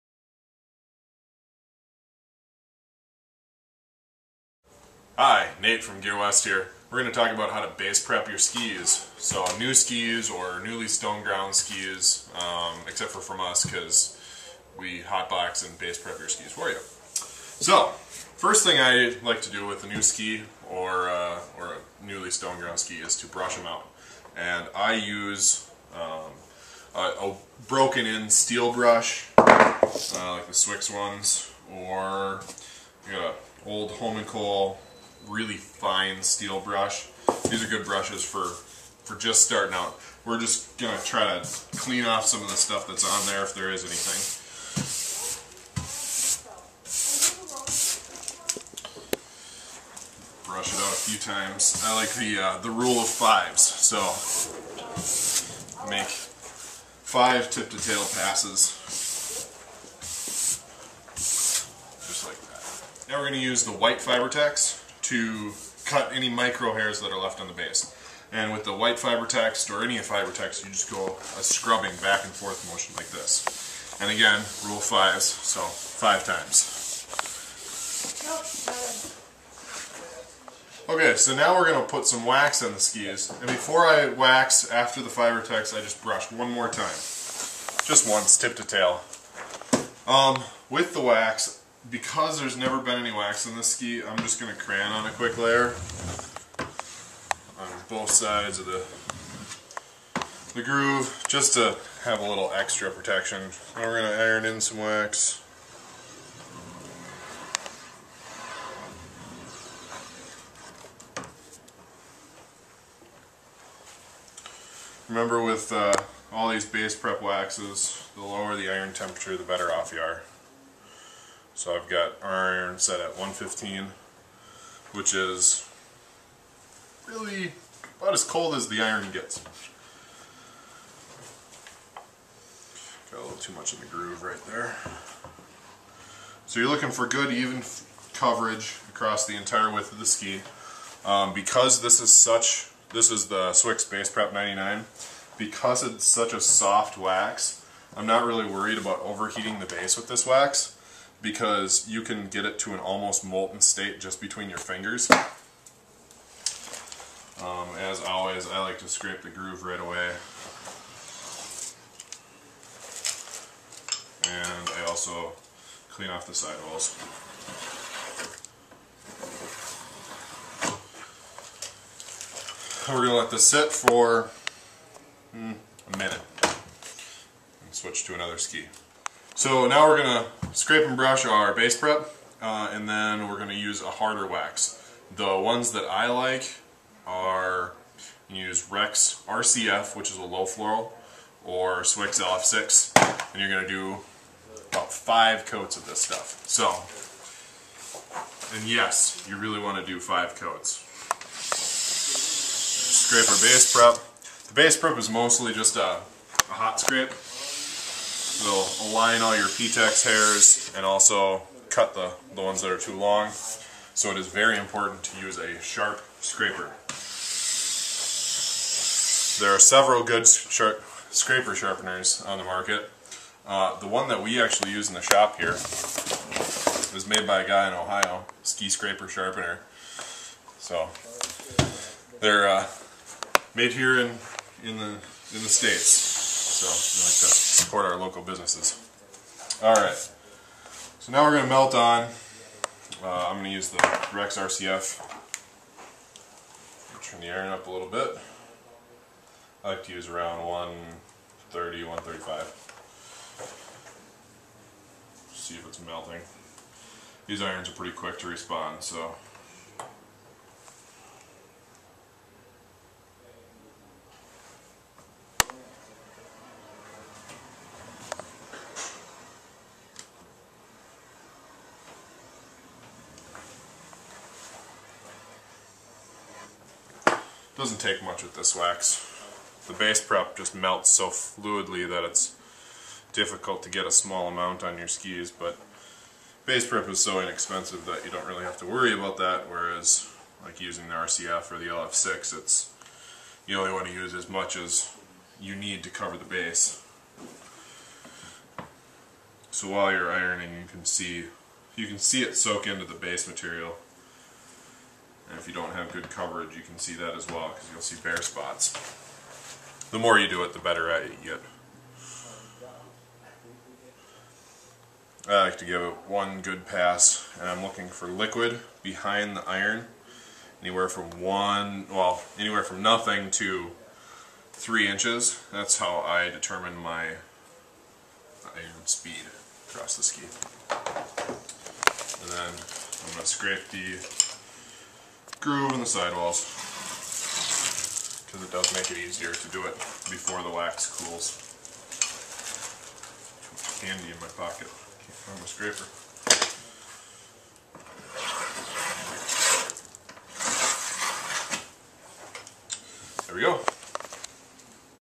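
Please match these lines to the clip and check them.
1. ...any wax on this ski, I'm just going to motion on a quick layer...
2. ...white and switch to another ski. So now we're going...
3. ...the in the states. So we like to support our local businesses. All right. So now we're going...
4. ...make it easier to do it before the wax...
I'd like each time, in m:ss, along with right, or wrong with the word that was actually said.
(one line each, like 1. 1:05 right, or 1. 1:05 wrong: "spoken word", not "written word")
1. 1:32 wrong: "crayon", not "motion"
2. 2:55 wrong: "minute", not "white"
3. 3:54 right
4. 5:38 right.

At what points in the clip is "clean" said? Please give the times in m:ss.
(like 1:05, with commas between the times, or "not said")
0:41, 2:45.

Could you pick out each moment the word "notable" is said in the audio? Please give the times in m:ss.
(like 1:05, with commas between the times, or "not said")
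not said.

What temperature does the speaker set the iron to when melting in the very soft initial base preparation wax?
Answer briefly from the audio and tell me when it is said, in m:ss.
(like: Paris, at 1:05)
115, at 2:03.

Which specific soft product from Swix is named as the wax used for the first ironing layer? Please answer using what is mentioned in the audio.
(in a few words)
Swix Base Prep 99.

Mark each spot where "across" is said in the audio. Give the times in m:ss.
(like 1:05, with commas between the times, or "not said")
2:18, 5:29.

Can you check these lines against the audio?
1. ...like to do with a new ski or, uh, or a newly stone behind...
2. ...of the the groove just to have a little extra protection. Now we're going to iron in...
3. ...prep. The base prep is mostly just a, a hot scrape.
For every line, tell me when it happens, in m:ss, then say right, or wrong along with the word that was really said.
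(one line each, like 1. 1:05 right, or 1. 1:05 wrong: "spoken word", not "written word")
1. 0:19 wrong: "ground", not "behind"
2. 1:38 right
3. 3:23 right.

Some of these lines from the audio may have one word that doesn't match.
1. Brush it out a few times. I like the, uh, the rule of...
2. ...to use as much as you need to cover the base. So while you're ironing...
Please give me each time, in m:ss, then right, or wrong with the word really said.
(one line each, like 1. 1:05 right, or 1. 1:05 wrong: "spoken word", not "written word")
1. 0:50 right
2. 4:53 right.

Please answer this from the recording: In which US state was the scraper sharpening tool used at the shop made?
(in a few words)
Ohio.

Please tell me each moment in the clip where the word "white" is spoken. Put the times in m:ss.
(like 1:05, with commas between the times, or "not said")
1:03, 1:08.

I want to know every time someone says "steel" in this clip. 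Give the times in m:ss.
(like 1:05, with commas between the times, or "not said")
0:28, 0:36.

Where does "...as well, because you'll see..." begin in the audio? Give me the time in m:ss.
5:07.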